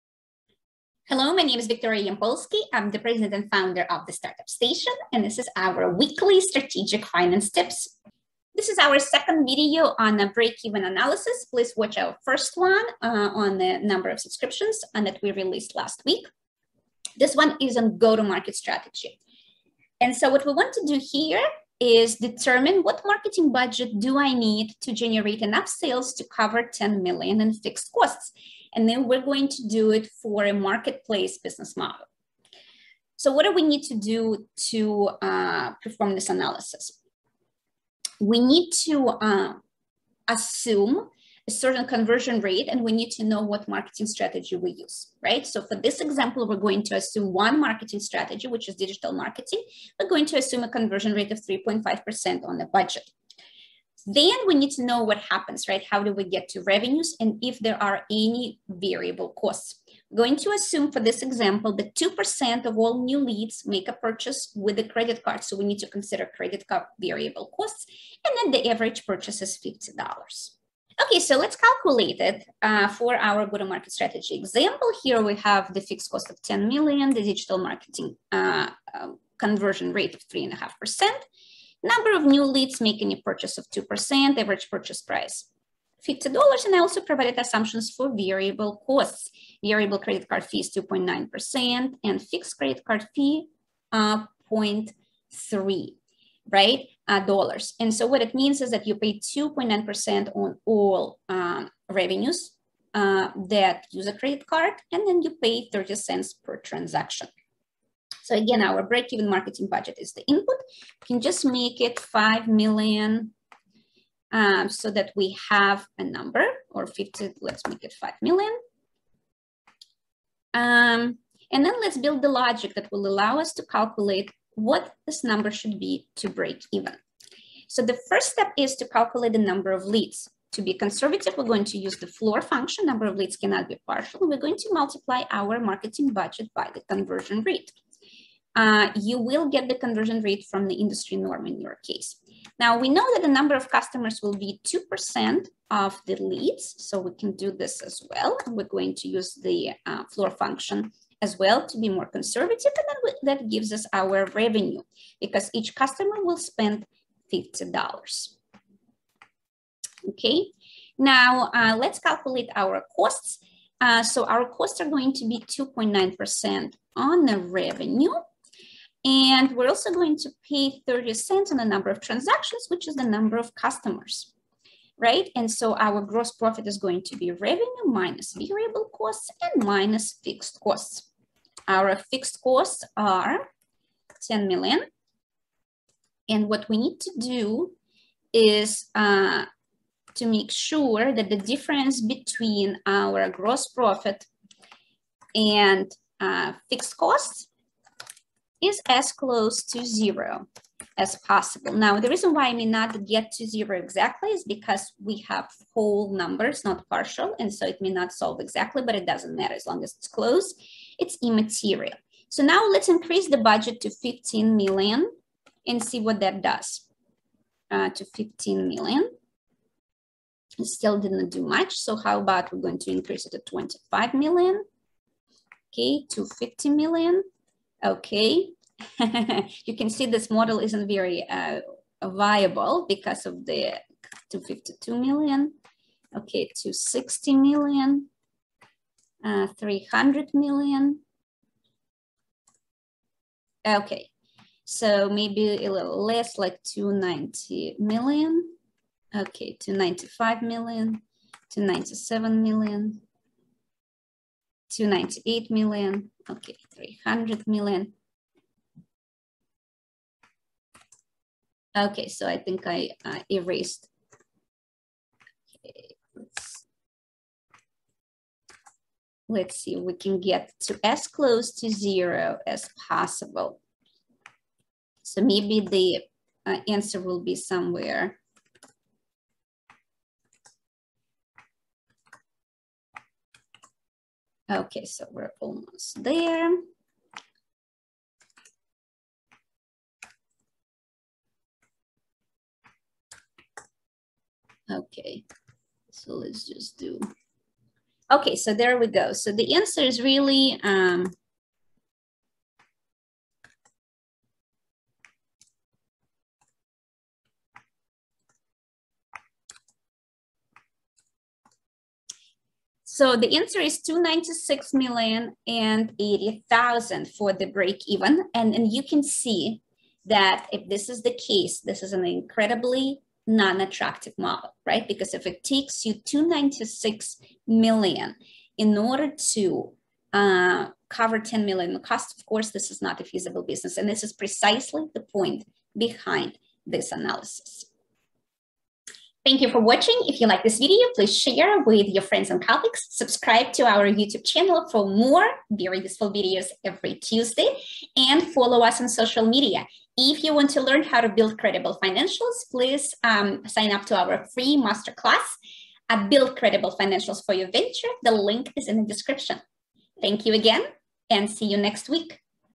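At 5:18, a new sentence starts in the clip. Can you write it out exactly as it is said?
And, and you can see that if this is the case, this is an incredibly non-attractive model, right?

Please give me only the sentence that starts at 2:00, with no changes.
Um, and then let's build the logic that will allow us to calculate what this number should be to break even.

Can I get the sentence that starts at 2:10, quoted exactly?
To be conservative, we're going to use the floor function.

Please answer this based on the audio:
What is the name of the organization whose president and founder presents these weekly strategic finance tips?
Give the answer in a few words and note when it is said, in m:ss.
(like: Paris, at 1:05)
Startup Station, at 0:04.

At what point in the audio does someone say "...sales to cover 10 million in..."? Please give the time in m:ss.
0:25.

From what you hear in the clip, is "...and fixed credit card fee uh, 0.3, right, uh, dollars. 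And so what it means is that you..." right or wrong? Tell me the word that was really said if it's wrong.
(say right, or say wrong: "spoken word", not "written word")
right.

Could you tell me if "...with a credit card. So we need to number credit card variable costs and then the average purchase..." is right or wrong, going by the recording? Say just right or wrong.
wrong.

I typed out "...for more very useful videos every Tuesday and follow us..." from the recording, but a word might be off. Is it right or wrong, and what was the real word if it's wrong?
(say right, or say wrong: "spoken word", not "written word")
right.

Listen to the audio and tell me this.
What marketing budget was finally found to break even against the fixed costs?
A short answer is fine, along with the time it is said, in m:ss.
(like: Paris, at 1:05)
296 million and 80,000, at 5:13.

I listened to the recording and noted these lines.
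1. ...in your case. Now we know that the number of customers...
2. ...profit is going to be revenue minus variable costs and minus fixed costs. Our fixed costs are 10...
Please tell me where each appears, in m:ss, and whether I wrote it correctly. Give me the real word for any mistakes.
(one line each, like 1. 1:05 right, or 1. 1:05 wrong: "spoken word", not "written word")
1. 2:21 right
2. 2:56 right.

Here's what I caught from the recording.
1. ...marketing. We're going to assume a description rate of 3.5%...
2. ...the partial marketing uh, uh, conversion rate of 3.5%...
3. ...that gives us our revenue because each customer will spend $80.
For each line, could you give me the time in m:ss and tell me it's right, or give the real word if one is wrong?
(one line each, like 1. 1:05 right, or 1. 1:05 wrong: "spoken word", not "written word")
1. 0:49 wrong: "conversion", not "description"
2. 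1:17 wrong: "digital", not "partial"
3. 2:33 wrong: "50", not "80".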